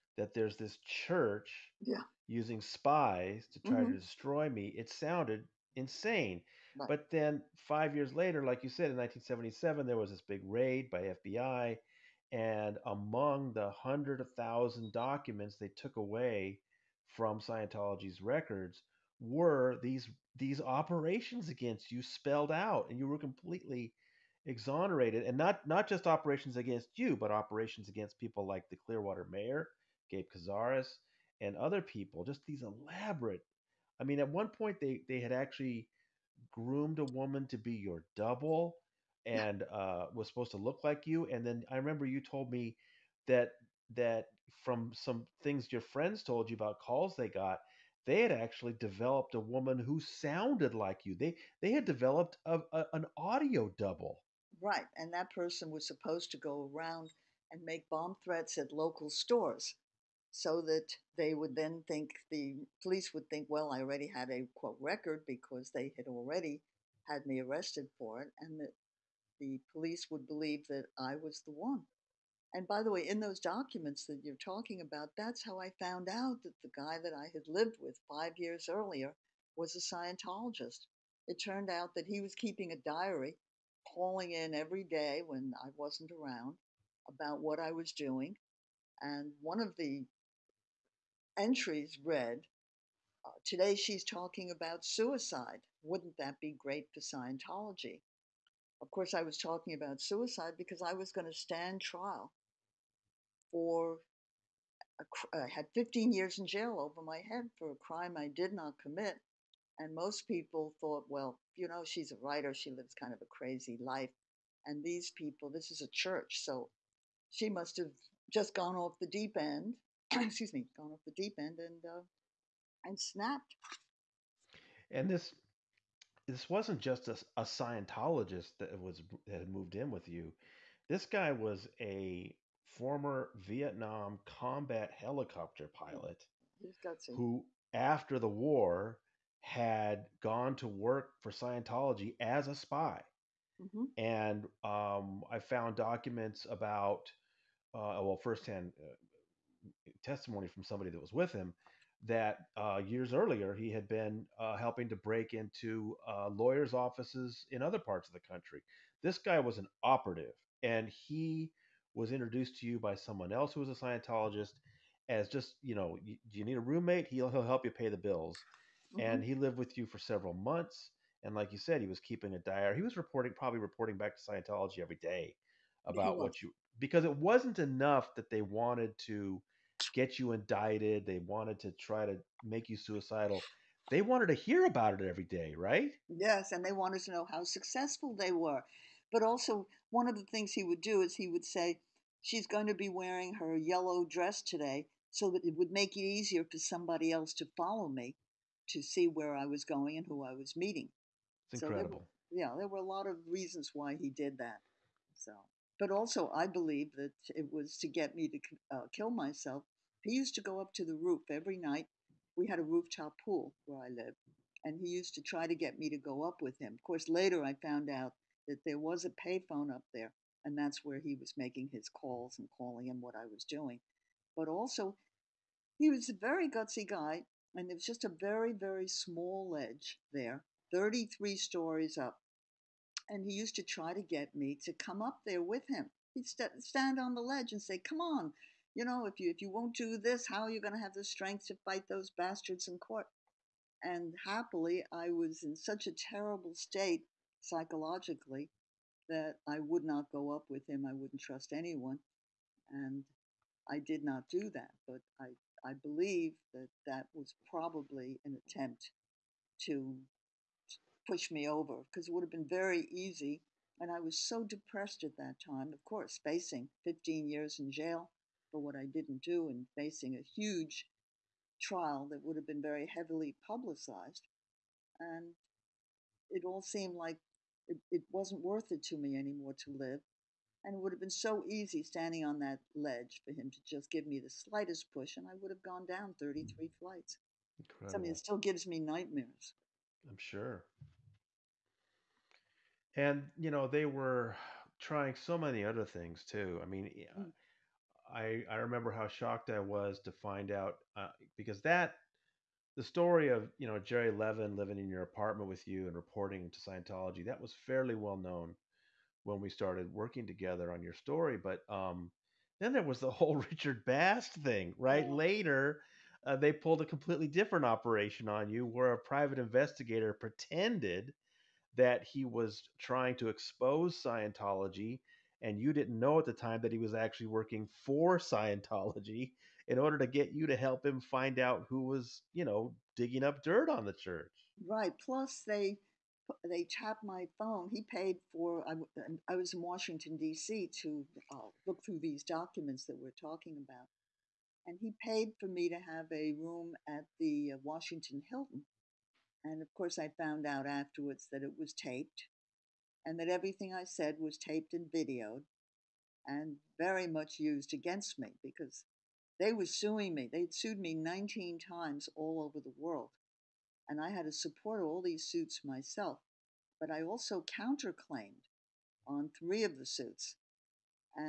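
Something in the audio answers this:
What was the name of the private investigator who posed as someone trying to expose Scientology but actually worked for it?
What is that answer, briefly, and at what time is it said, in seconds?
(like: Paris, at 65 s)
Richard Bast, at 313 s.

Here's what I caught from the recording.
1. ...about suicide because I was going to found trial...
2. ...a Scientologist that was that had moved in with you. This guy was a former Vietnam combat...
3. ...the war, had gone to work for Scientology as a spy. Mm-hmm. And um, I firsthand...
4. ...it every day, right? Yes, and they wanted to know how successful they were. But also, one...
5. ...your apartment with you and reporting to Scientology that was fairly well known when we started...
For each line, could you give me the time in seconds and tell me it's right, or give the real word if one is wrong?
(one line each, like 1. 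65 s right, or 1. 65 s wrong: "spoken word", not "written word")
1. 99 s wrong: "stand", not "found"
2. 127 s right
3. 138 s wrong: "found", not "firsthand"
4. 185 s right
5. 304 s right.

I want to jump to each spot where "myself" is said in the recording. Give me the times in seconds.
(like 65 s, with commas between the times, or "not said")
209 s, 365 s.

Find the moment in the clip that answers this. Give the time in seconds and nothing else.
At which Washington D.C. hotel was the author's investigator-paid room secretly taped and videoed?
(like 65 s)
347 s.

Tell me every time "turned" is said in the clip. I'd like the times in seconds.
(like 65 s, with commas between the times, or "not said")
81 s.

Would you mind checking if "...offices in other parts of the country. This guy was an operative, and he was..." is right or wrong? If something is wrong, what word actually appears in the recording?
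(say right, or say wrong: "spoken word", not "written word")
right.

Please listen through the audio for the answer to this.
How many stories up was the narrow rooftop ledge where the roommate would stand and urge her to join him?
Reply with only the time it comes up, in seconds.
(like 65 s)
230 s.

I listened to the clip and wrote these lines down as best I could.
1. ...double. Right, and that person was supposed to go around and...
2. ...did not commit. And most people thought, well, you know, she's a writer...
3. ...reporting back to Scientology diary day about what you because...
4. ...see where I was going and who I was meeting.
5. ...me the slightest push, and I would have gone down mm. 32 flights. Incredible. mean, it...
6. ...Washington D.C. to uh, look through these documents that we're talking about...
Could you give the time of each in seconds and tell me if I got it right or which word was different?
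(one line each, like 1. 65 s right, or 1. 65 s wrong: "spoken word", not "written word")
1. 53 s right
2. 108 s right
3. 173 s wrong: "every", not "diary"
4. 198 s right
5. 284 s wrong: "33", not "32"
6. 339 s right.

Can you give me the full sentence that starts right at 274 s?
And it all seemed like it, it wasn't worth it to me anymore to live.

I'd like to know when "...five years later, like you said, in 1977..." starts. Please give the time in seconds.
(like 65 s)
7 s.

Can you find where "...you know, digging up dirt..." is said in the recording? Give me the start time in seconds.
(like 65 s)
332 s.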